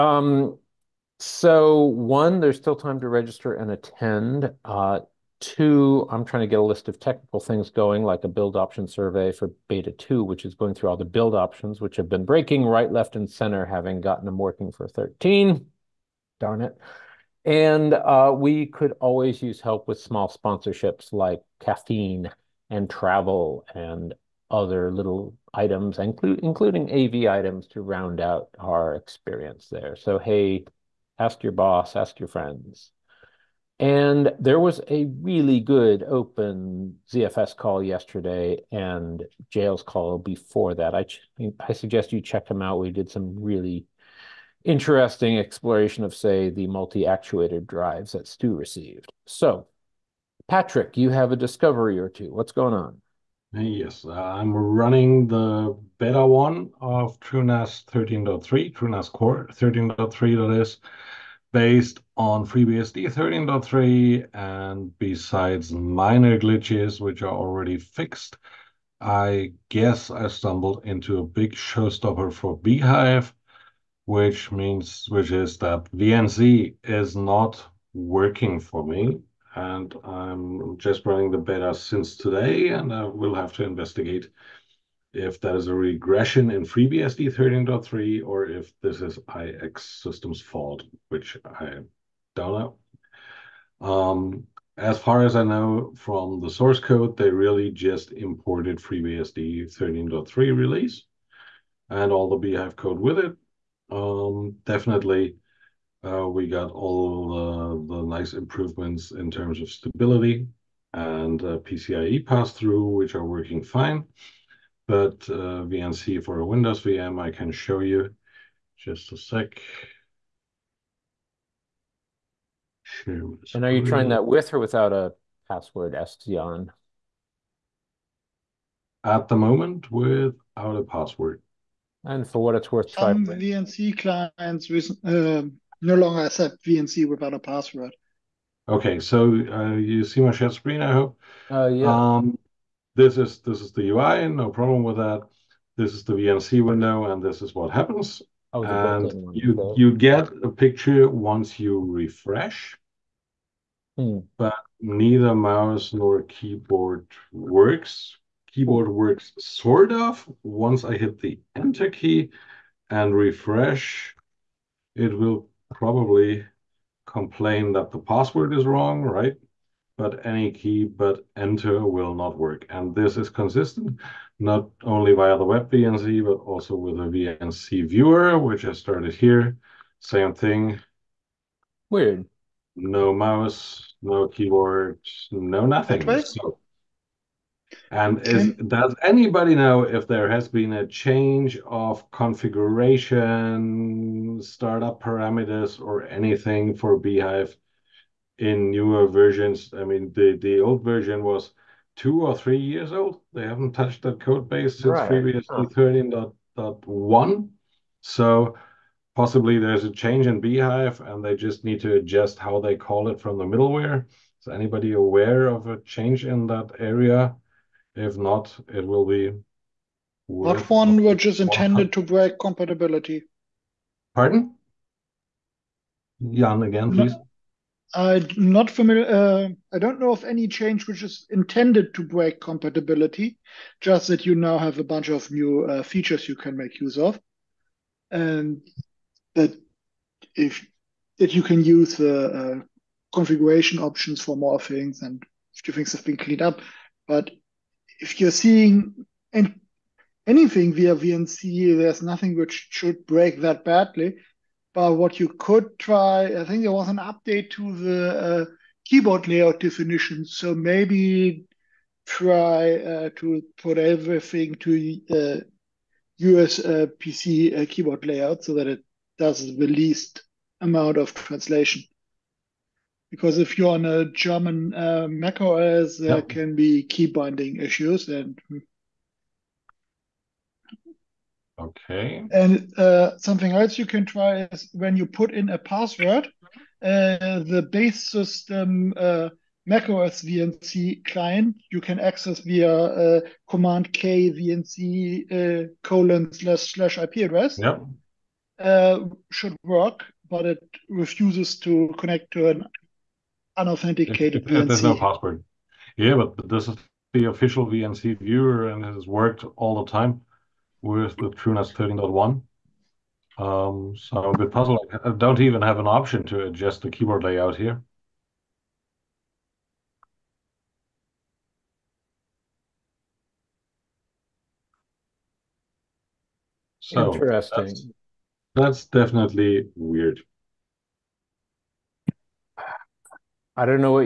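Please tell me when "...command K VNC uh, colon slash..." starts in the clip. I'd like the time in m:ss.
4:53.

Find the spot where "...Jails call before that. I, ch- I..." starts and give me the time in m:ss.
0:39.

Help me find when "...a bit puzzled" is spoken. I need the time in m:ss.
5:14.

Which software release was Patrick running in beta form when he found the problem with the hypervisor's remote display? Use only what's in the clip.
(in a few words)
TrueNAS Core 13.3.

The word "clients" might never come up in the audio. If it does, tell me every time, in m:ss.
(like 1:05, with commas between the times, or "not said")
2:13, 4:51.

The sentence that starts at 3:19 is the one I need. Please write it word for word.
I mean, the, the old version was two or three years old.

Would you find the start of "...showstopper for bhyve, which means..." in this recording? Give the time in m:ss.
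1:11.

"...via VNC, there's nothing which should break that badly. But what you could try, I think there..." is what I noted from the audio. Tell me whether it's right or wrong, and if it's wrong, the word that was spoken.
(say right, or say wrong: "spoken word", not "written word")
right.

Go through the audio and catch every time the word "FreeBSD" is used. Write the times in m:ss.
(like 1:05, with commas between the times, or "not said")
1:02, 1:26, 1:38.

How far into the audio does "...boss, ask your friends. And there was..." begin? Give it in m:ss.
0:31.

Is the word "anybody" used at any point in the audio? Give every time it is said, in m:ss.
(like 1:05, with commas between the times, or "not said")
3:09, 3:34.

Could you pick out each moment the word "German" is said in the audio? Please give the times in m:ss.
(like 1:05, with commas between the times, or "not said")
4:34.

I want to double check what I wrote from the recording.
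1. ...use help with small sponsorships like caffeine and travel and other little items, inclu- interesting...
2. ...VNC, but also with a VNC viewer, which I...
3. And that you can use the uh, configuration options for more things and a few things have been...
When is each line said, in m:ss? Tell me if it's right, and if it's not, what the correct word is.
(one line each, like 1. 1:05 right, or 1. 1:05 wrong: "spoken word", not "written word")
1. 0:19 wrong: "including", not "interesting"
2. 2:55 right
3. 3:58 right.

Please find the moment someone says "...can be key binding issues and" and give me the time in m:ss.
4:36.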